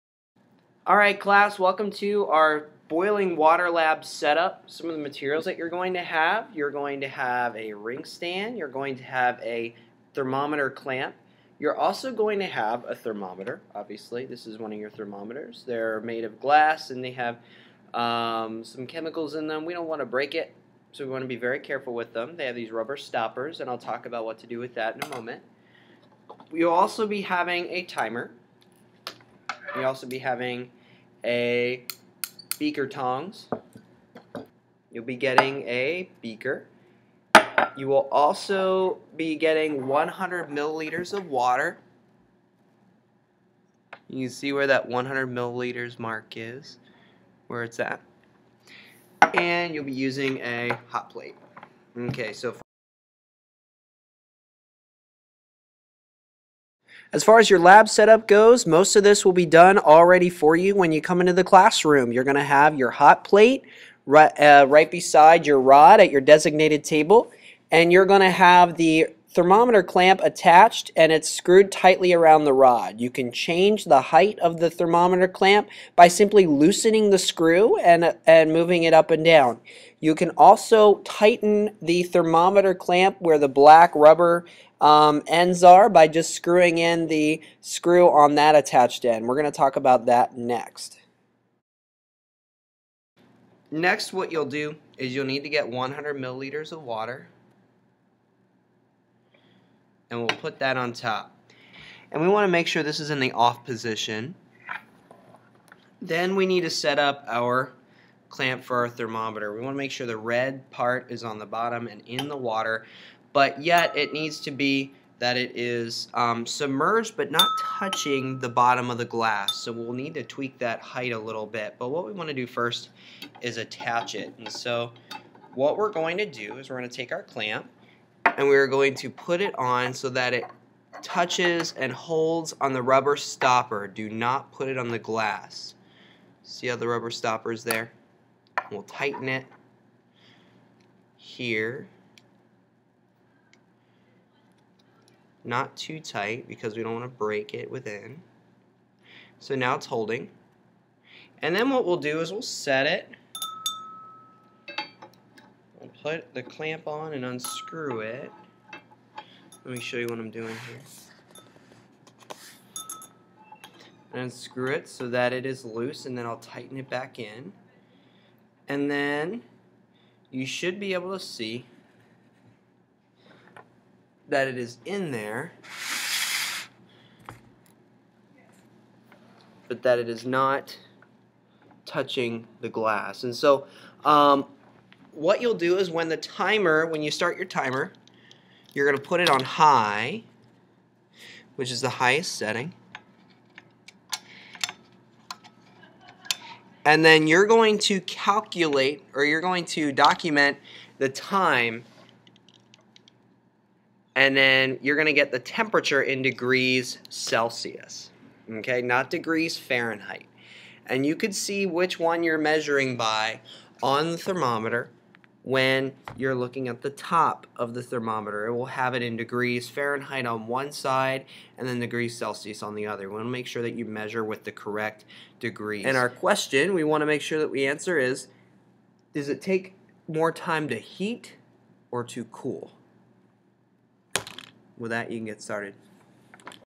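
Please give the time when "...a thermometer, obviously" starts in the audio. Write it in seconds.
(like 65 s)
12 s.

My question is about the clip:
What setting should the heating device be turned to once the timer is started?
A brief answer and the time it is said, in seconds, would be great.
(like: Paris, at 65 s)
high, at 189 s.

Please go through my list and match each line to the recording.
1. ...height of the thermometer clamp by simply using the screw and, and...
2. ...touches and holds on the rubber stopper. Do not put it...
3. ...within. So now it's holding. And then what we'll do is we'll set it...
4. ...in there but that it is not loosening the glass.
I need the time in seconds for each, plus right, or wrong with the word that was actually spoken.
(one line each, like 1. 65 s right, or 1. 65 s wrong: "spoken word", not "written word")
1. 74 s wrong: "loosening", not "using"
2. 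131 s right
3. 147 s right
4. 174 s wrong: "touching", not "loosening".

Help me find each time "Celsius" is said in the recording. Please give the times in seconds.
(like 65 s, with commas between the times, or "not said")
207 s, 222 s.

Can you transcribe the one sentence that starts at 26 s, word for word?
You'll also be having a timer we also be having a beaker tongs.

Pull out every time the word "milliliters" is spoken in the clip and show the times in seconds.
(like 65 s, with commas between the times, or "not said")
40 s, 45 s, 96 s.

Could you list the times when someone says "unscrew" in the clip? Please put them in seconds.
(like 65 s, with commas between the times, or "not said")
157 s, 164 s.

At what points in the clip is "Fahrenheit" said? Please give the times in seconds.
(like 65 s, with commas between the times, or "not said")
209 s, 219 s.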